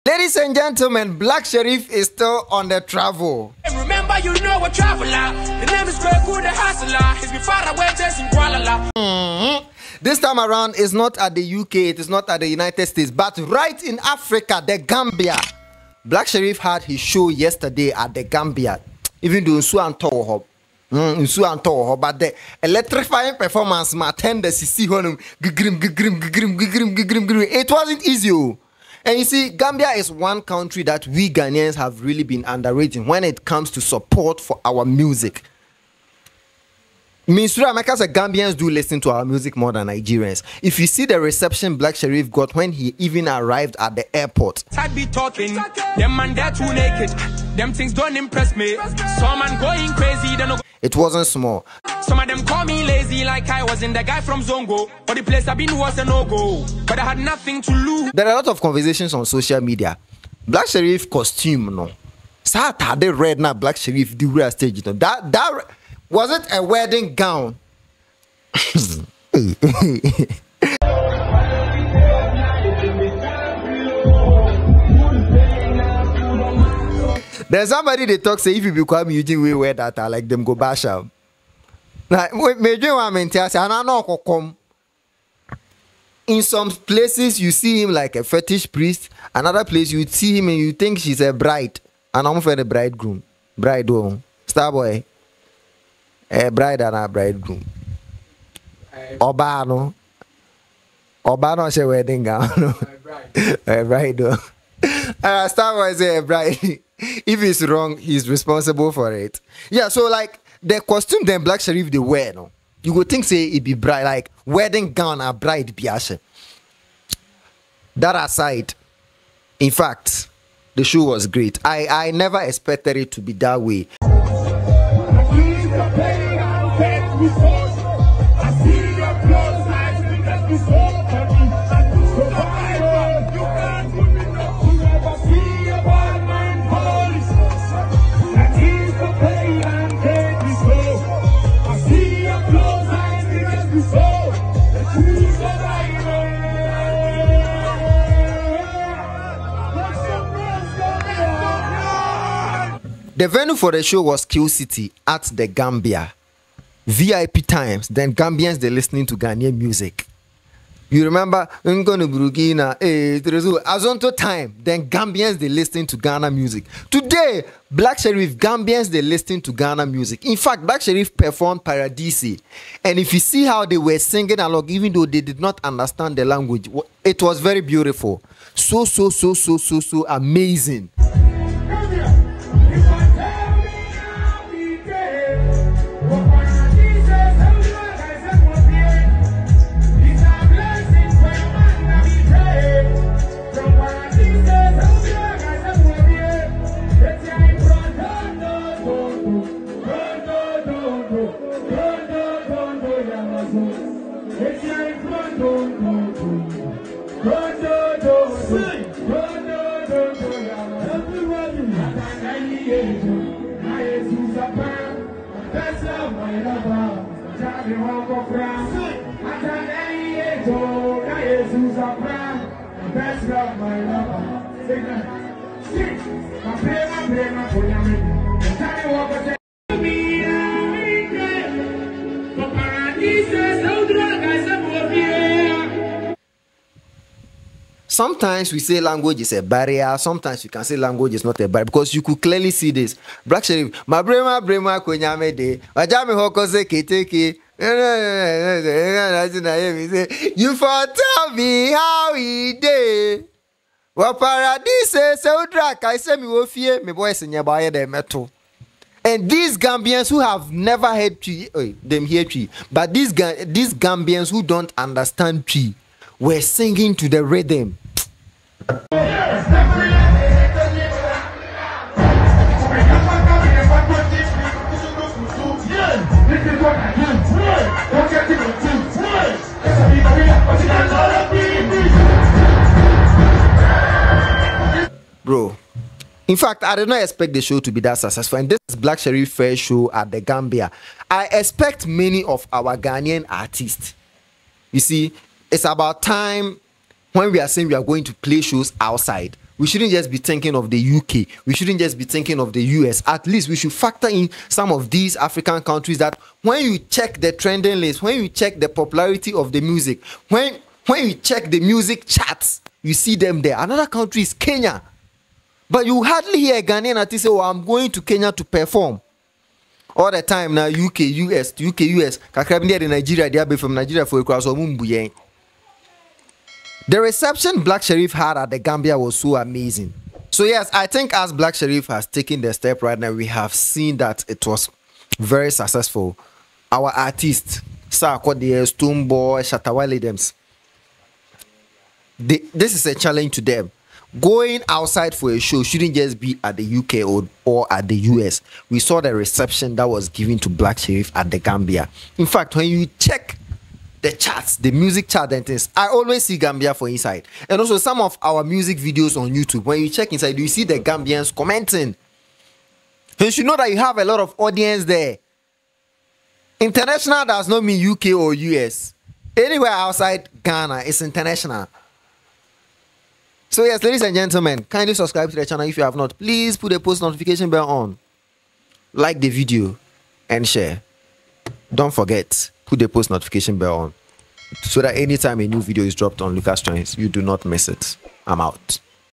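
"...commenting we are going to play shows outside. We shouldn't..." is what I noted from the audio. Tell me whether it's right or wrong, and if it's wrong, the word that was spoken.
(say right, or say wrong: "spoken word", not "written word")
wrong: "saying", not "commenting".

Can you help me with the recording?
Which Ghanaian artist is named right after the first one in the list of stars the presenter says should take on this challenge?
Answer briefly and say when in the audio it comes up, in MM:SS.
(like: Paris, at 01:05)
Stonebwoy, at 05:38.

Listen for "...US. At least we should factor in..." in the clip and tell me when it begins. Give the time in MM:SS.
05:02.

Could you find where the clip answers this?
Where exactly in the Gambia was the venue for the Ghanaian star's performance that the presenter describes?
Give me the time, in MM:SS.
02:34.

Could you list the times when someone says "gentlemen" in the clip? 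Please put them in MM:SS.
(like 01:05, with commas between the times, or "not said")
00:00, 06:14.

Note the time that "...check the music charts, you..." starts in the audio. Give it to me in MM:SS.
05:11.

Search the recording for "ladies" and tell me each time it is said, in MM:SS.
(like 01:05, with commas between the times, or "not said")
00:00, 06:13.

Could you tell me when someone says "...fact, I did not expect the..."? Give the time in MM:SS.
04:46.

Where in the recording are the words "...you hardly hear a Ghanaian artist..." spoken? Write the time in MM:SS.
05:15.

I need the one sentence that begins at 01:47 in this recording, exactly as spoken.
if it's wrong, he's responsible for it.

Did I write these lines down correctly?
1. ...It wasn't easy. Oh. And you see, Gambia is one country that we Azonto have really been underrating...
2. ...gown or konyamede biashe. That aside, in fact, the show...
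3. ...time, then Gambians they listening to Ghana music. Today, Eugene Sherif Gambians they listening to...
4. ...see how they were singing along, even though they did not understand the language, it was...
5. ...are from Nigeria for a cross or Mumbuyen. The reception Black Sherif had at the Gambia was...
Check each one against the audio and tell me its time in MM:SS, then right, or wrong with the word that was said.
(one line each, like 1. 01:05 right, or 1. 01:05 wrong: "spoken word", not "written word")
1. 00:27 wrong: "Ghanaians", not "Azonto"
2. 01:54 wrong: "bride", not "konyamede"
3. 02:44 wrong: "Black", not "Eugene"
4. 02:53 right
5. 05:23 right.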